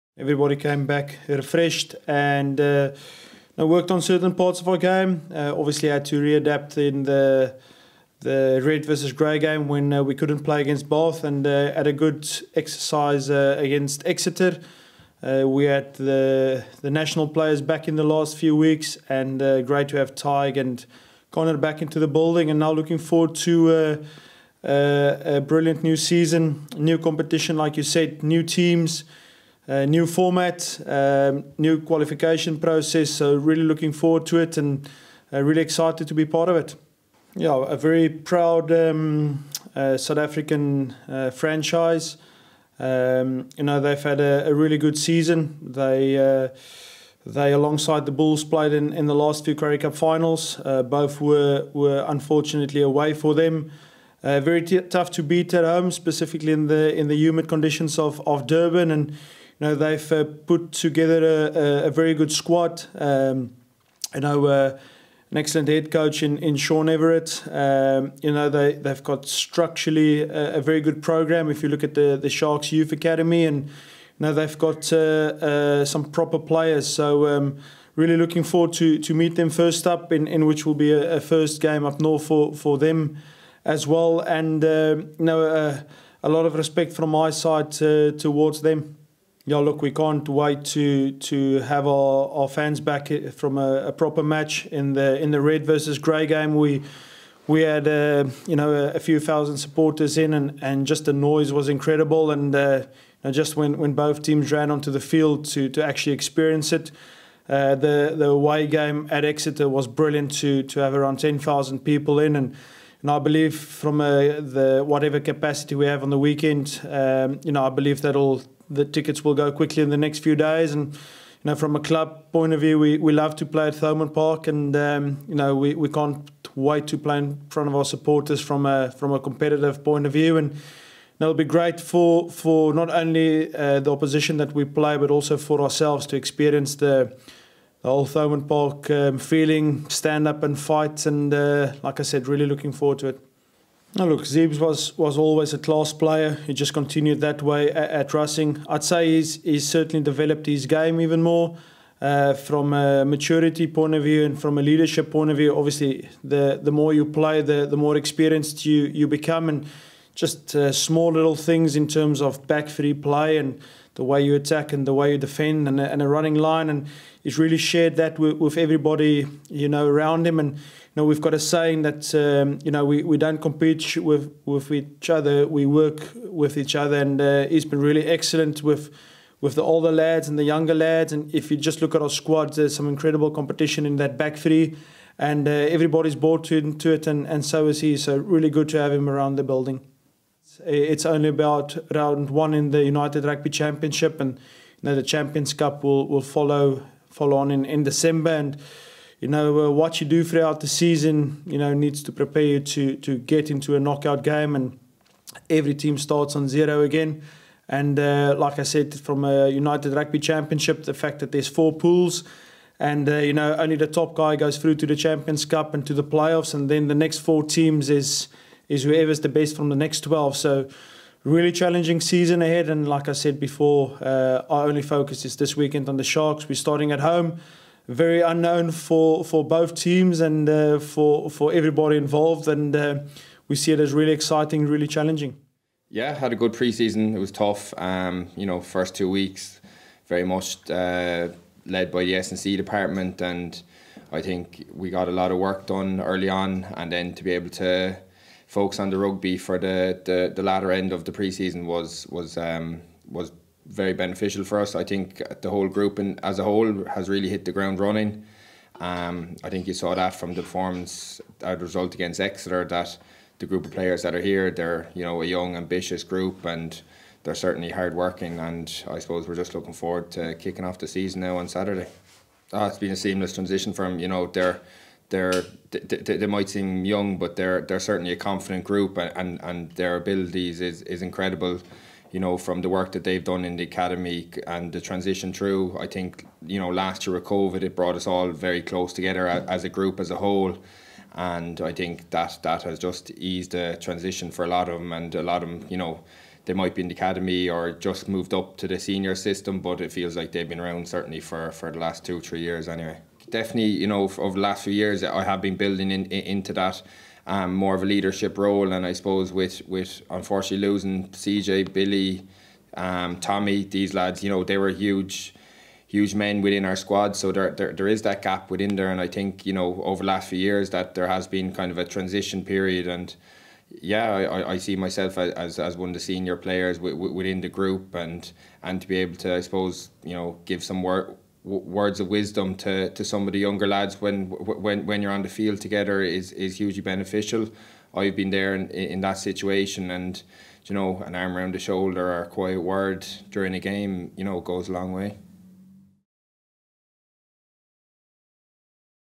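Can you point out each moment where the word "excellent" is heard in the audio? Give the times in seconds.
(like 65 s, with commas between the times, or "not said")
65 s, 178 s.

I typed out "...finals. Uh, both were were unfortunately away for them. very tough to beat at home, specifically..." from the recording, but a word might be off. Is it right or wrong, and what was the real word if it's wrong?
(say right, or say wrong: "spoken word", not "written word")
right.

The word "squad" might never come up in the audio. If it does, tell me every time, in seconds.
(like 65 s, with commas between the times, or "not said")
62 s, 182 s, 316 s.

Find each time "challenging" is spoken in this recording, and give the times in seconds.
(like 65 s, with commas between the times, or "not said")
221 s, 234 s.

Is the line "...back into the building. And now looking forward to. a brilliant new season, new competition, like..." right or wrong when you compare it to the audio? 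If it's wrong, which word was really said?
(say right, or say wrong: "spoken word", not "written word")
right.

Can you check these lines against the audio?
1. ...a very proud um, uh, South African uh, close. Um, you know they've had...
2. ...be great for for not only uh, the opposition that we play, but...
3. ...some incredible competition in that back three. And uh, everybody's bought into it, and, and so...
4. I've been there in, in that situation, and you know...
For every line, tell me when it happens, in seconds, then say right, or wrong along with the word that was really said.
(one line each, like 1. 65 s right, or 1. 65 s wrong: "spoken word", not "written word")
1. 37 s wrong: "franchise", not "close"
2. 131 s right
3. 182 s right
4. 337 s right.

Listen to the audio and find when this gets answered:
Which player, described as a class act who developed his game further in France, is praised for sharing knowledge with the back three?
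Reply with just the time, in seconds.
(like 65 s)
144 s.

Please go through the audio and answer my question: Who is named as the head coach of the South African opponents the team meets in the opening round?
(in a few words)
Sean Everitt.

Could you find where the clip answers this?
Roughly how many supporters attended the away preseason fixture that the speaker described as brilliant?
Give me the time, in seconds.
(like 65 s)
111 s.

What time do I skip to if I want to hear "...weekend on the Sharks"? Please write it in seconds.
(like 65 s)
225 s.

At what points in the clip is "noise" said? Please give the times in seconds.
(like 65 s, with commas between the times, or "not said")
101 s.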